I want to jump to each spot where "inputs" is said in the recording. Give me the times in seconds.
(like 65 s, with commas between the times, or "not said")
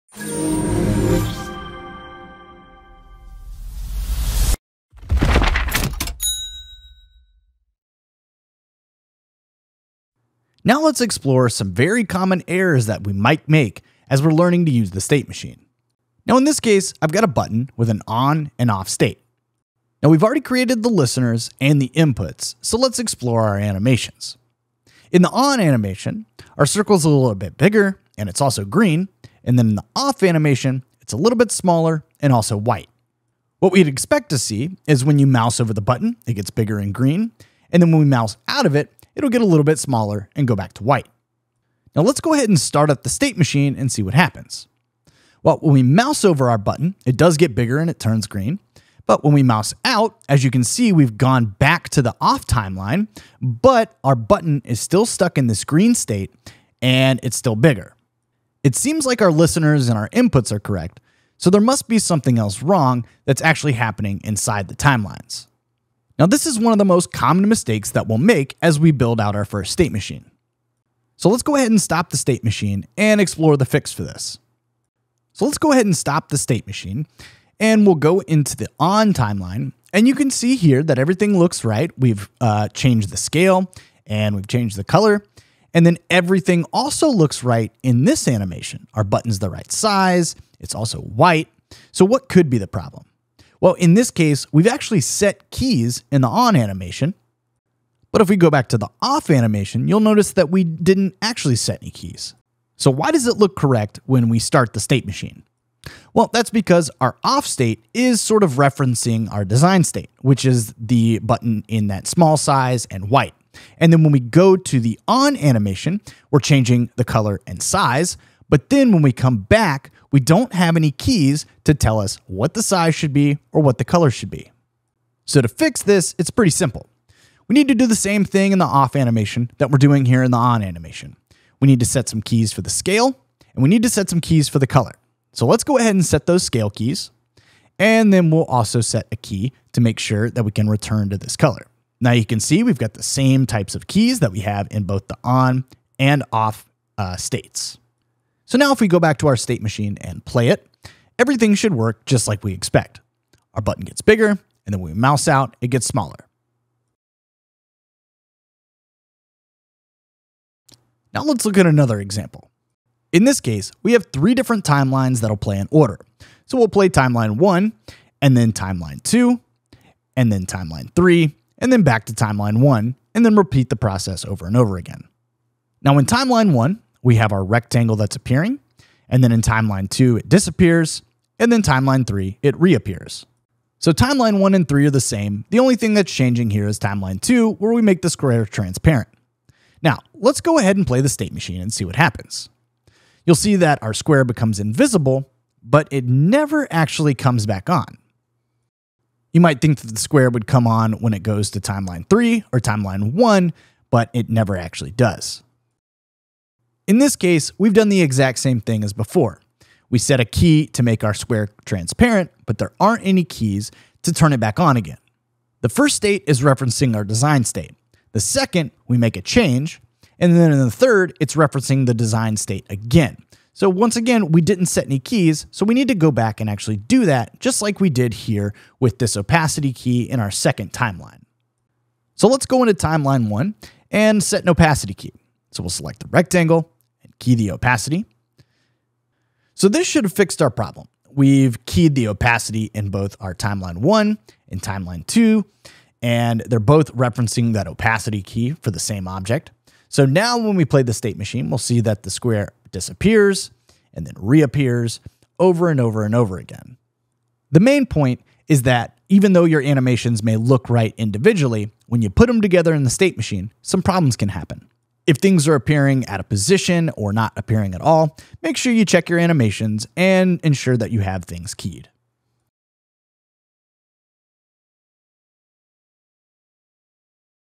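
21 s, 60 s.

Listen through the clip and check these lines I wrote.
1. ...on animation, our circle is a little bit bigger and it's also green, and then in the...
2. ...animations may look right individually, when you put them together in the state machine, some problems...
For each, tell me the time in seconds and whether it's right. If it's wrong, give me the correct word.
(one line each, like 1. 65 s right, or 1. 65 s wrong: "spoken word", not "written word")
1. 25 s right
2. 259 s right.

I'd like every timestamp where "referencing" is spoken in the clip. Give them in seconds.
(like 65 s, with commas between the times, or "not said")
108 s, 216 s, 221 s, 246 s.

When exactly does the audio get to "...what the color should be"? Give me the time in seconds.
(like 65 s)
123 s.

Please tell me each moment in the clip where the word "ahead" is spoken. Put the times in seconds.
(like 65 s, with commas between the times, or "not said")
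42 s, 71 s, 75 s, 135 s, 190 s.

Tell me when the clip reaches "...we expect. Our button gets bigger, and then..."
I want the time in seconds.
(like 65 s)
152 s.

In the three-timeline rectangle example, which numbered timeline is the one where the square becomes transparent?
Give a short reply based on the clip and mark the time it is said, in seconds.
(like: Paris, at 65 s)
timeline 2, at 186 s.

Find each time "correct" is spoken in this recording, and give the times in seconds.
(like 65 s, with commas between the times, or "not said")
60 s, 103 s.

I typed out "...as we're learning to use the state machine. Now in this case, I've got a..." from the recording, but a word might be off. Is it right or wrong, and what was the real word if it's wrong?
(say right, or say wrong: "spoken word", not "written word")
right.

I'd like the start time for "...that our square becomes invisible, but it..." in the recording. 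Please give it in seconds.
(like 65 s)
193 s.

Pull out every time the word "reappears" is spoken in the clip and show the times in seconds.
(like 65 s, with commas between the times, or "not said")
182 s, 254 s.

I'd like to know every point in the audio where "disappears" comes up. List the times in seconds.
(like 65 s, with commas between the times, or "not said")
180 s, 252 s.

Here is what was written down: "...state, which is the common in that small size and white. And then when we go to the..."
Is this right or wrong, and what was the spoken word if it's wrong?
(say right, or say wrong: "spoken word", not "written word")
wrong: "button", not "common".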